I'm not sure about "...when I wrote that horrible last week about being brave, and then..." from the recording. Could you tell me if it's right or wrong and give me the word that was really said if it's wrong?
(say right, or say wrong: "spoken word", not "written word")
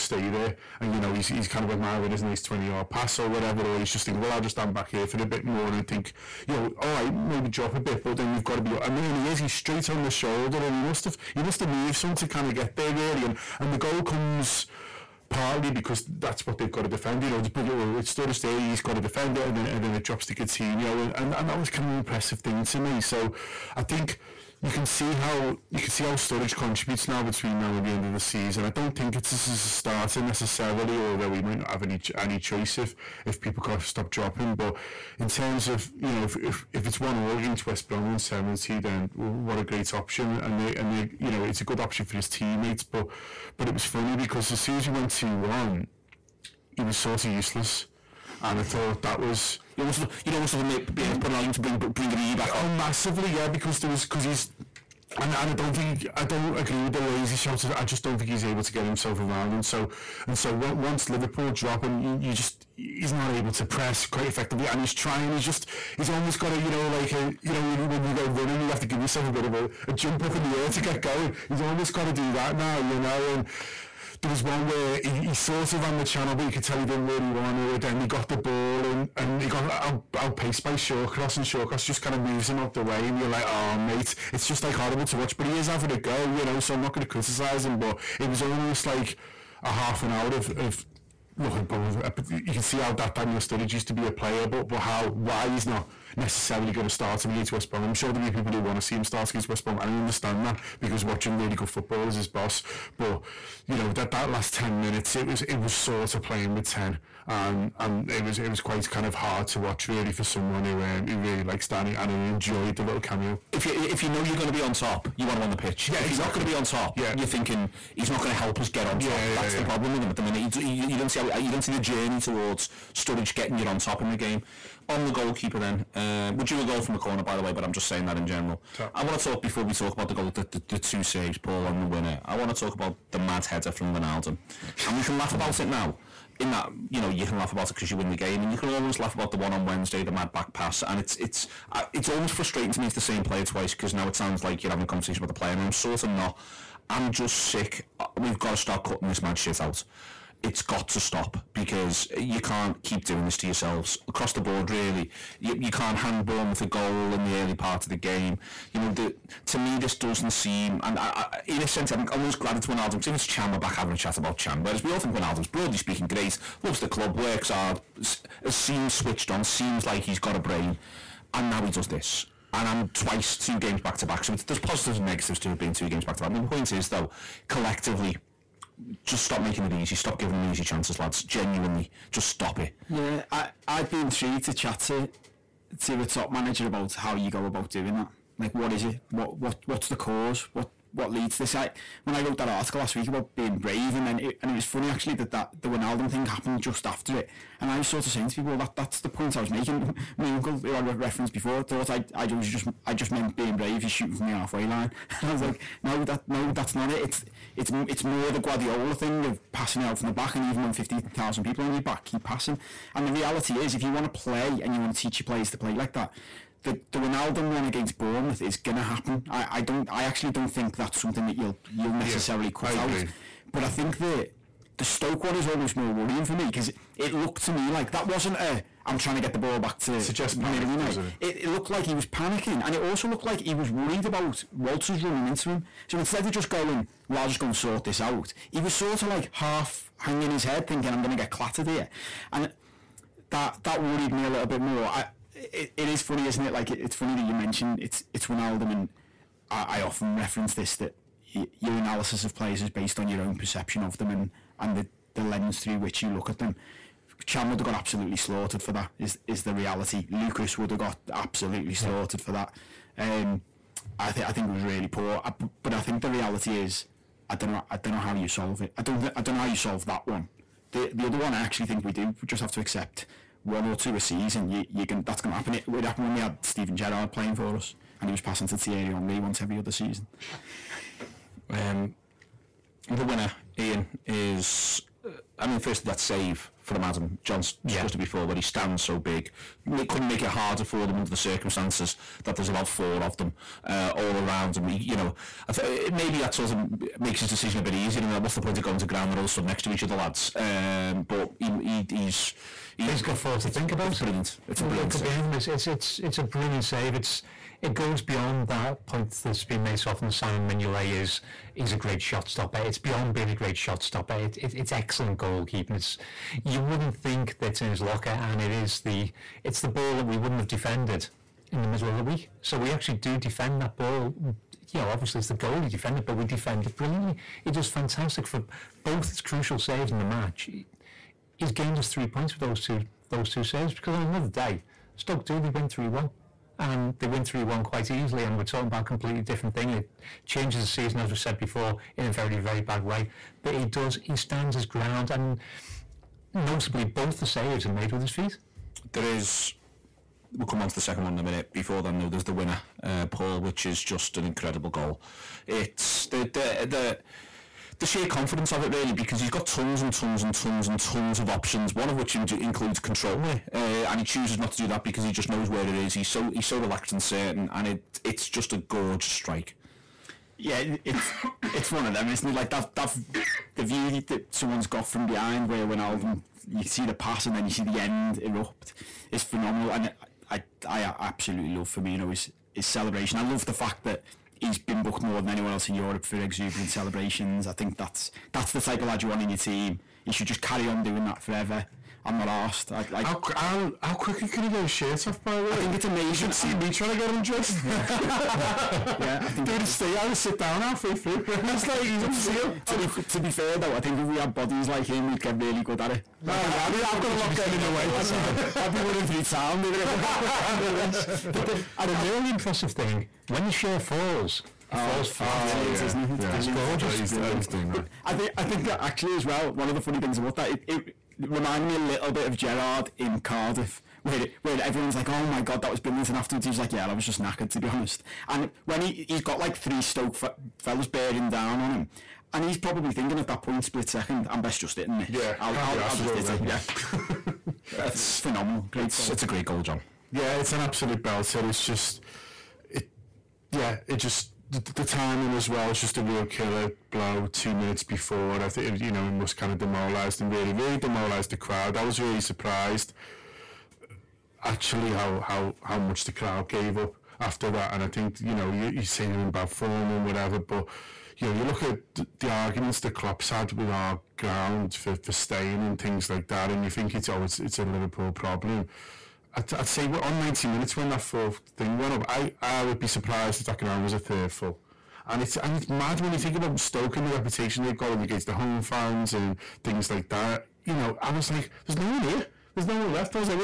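wrong: "article", not "horrible".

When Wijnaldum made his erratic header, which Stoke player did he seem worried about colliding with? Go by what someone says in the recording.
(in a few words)
Walters.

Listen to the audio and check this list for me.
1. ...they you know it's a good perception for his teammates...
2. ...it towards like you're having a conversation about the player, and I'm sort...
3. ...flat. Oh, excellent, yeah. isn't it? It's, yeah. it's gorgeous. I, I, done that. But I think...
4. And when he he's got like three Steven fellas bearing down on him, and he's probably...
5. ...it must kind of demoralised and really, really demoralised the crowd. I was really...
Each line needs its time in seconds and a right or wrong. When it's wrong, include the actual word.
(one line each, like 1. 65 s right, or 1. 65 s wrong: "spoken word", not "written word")
1. 40 s wrong: "option", not "perception"
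2. 144 s wrong: "sounds", not "towards"
3. 415 s wrong: "brilliant", not "excellent"
4. 428 s wrong: "Stoke", not "Steven"
5. 449 s right.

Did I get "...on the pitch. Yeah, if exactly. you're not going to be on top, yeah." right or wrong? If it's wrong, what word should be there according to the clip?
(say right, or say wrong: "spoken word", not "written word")
right.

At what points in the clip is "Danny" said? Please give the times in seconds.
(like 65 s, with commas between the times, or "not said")
111 s.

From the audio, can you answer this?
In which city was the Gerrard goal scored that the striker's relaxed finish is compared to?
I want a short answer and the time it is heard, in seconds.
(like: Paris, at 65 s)
Cardiff, at 423 s.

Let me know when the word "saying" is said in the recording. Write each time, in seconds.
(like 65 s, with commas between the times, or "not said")
127 s, 198 s.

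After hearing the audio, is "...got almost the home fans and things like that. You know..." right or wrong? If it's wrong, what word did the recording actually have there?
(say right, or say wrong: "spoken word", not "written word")
wrong: "against", not "almost".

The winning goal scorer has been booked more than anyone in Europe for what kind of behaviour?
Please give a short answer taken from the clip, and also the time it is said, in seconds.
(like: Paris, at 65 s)
exuberant celebrations, at 386 s.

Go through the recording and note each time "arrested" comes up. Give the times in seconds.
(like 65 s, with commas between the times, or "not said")
not said.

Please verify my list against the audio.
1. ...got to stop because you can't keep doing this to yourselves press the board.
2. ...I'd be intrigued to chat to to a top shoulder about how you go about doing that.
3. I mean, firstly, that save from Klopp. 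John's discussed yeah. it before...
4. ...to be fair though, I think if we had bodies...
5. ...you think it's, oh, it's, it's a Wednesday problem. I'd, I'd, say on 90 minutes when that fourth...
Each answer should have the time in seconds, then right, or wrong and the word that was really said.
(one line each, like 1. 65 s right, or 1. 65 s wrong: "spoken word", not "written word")
1. 150 s wrong: "across", not "press"
2. 183 s wrong: "manager", not "shoulder"
3. 285 s wrong: "Adam", not "Klopp"
4. 402 s right
5. 466 s wrong: "Liverpool", not "Wednesday".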